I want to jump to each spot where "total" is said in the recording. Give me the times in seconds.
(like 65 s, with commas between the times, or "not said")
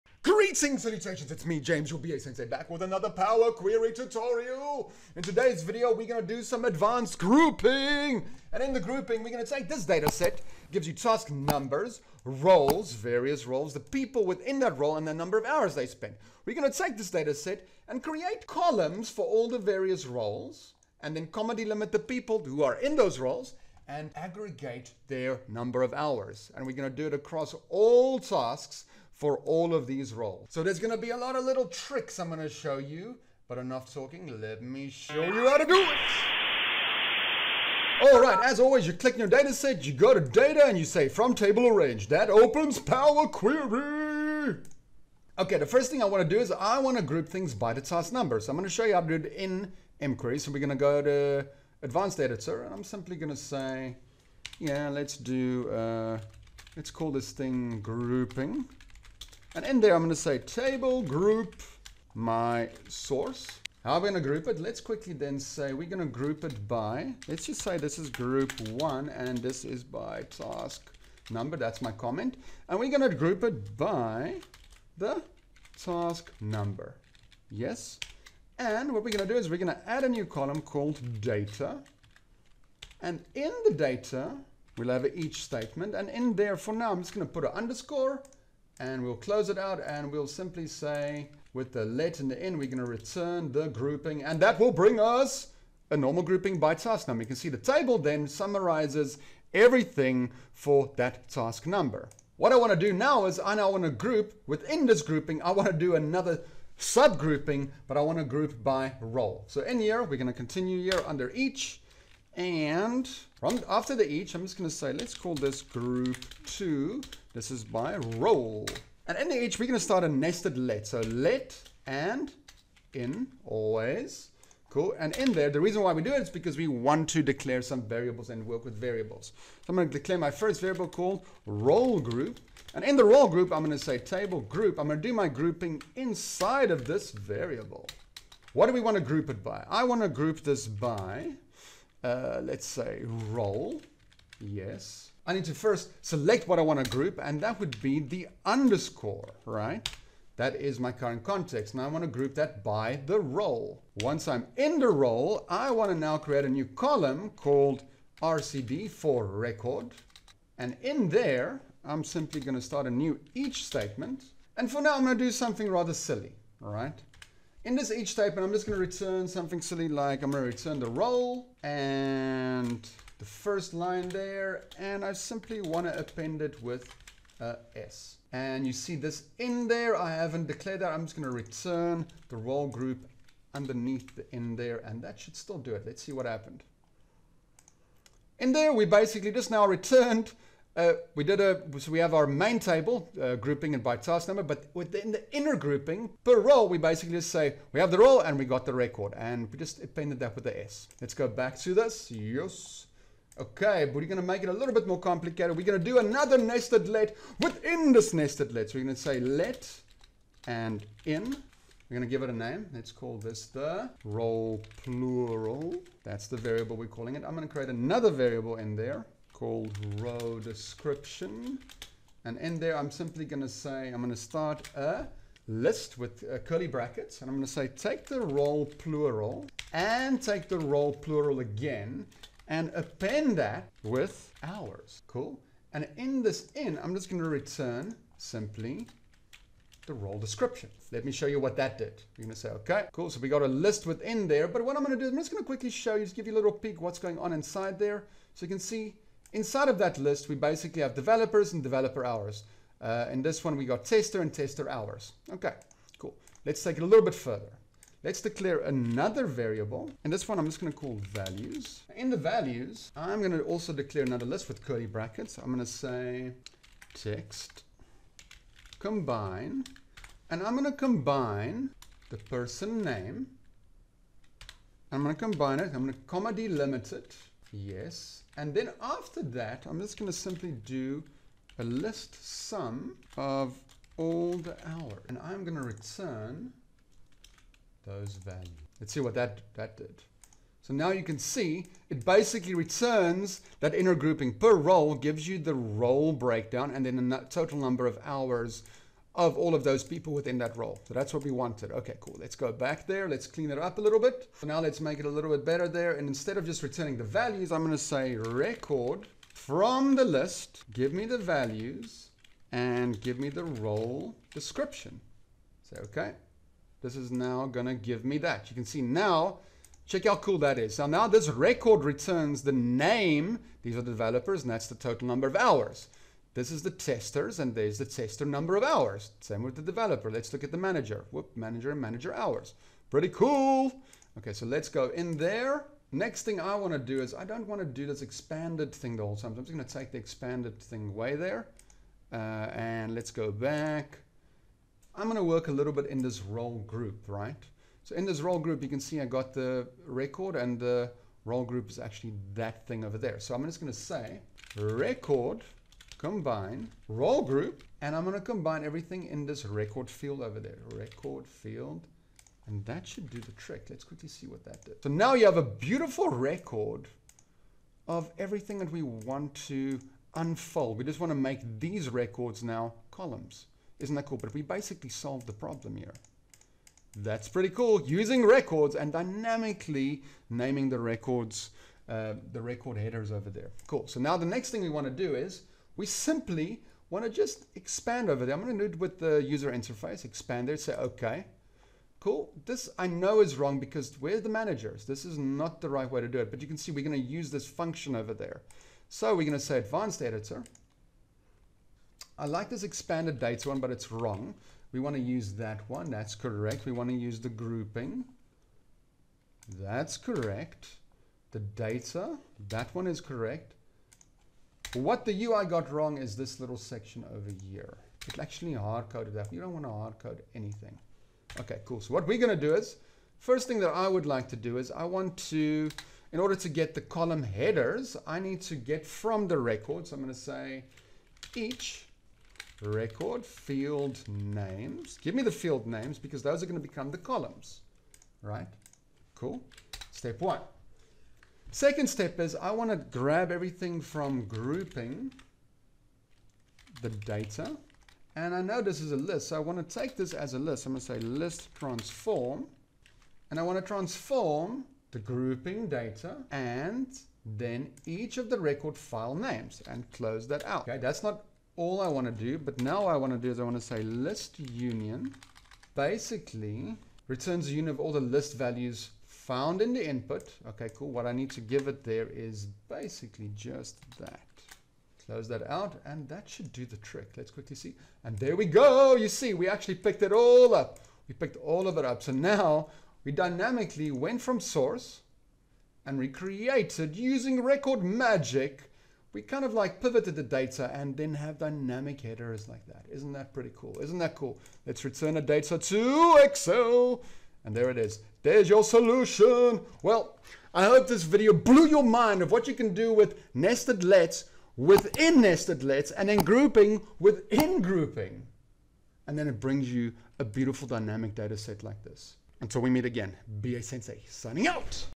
297 s, 324 s.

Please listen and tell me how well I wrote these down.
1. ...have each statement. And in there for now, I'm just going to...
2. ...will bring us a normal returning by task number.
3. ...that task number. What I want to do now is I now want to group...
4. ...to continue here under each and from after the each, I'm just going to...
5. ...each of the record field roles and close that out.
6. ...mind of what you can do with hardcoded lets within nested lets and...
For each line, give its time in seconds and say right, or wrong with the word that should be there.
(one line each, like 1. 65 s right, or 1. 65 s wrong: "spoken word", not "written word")
1. 84 s right
2. 94 s wrong: "grouping", not "returning"
3. 100 s right
4. 110 s right
5. 457 s wrong: "names", not "roles"
6. 501 s wrong: "nested", not "hardcoded".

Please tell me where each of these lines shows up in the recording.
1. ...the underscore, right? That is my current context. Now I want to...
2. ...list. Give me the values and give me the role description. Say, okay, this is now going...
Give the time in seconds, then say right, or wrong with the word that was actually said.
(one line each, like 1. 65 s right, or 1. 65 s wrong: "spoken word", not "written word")
1. 147 s right
2. 310 s right.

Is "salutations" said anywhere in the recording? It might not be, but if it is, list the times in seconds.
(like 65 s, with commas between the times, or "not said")
0 s.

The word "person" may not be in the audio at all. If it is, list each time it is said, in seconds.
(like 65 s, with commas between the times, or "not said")
272 s.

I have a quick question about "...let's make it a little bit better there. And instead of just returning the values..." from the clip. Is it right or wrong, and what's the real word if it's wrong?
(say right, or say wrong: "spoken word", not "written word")
right.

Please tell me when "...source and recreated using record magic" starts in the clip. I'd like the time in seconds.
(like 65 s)
484 s.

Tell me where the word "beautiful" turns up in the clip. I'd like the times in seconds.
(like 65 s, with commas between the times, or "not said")
365 s, 510 s.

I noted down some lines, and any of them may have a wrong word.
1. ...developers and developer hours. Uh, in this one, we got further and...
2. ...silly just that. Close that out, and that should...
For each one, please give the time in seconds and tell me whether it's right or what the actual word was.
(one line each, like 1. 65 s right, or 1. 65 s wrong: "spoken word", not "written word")
1. 250 s wrong: "tester", not "further"
2. 472 s wrong: "basically", not "silly".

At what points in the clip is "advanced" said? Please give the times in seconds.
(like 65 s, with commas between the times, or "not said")
6 s, 51 s, 399 s.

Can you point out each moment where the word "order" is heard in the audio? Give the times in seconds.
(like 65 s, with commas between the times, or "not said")
426 s.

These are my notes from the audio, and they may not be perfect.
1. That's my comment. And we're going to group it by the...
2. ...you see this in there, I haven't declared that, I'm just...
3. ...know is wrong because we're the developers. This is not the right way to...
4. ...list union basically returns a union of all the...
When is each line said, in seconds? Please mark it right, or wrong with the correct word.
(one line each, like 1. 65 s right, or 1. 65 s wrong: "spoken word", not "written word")
1. 71 s right
2. 178 s right
3. 392 s wrong: "managers", not "developers"
4. 463 s right.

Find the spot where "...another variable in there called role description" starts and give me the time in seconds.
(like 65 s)
217 s.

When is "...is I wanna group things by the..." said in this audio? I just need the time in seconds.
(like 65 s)
46 s.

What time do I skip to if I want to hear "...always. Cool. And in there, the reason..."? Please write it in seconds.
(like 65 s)
123 s.